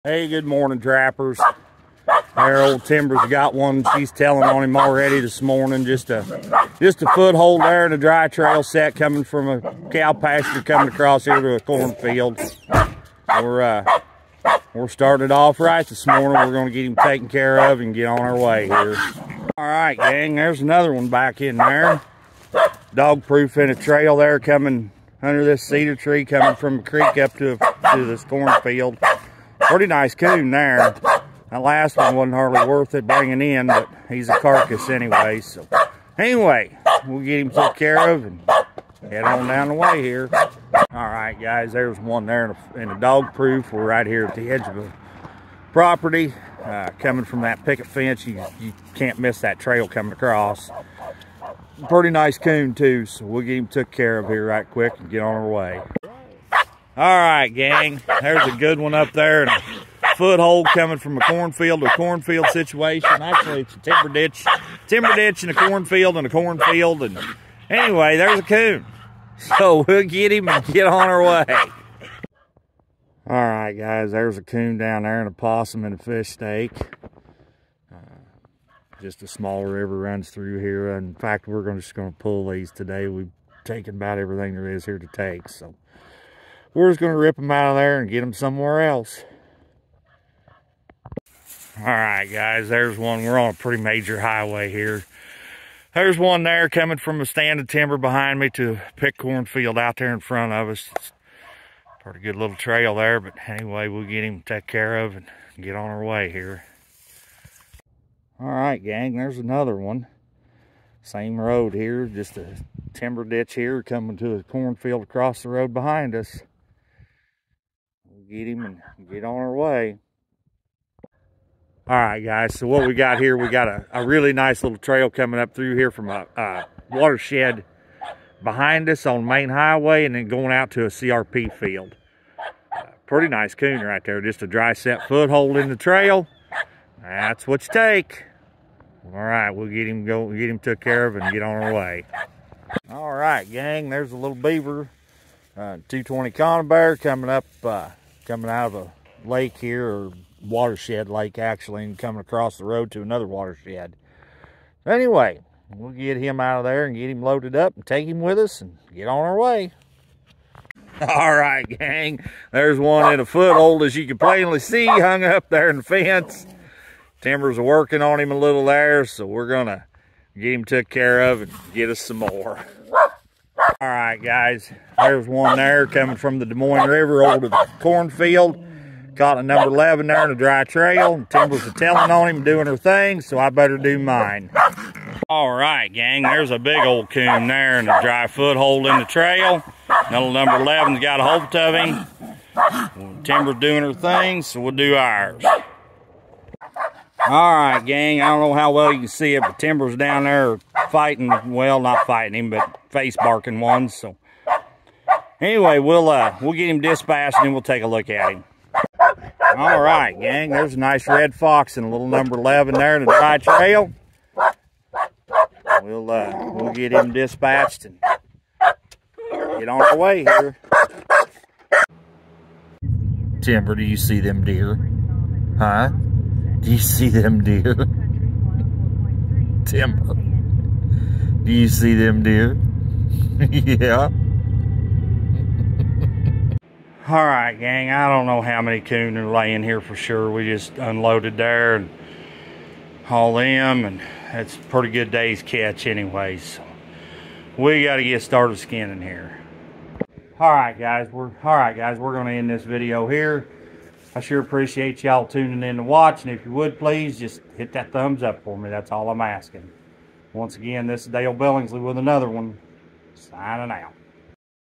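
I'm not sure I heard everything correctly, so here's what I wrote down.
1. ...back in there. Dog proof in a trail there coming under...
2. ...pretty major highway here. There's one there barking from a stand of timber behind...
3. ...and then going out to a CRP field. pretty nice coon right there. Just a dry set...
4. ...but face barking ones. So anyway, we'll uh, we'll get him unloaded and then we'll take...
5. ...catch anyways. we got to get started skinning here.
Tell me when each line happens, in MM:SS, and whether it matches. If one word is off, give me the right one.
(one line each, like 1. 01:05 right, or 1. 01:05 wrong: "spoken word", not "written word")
1. 00:21 right
2. 01:33 wrong: "coming", not "barking"
3. 02:10 right
4. 03:22 wrong: "dispatched", not "unloaded"
5. 04:05 right.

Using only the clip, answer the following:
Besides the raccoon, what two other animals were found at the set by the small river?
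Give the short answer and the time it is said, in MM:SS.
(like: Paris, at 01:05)
A possum and a fish, at 01:15.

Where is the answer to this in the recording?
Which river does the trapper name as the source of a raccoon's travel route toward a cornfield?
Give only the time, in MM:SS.
02:56.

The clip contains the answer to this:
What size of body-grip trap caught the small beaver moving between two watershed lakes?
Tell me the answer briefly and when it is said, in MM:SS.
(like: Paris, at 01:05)
220, at 02:25.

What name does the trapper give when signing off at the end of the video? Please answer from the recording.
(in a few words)
Dale Billingsley.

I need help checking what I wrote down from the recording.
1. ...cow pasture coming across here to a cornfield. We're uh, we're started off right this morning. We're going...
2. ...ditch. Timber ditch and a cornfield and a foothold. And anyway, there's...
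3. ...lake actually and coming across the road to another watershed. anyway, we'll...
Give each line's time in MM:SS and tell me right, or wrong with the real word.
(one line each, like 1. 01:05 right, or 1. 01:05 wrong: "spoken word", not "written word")
1. 00:09 right
2. 01:04 wrong: "cornfield", not "foothold"
3. 02:31 right.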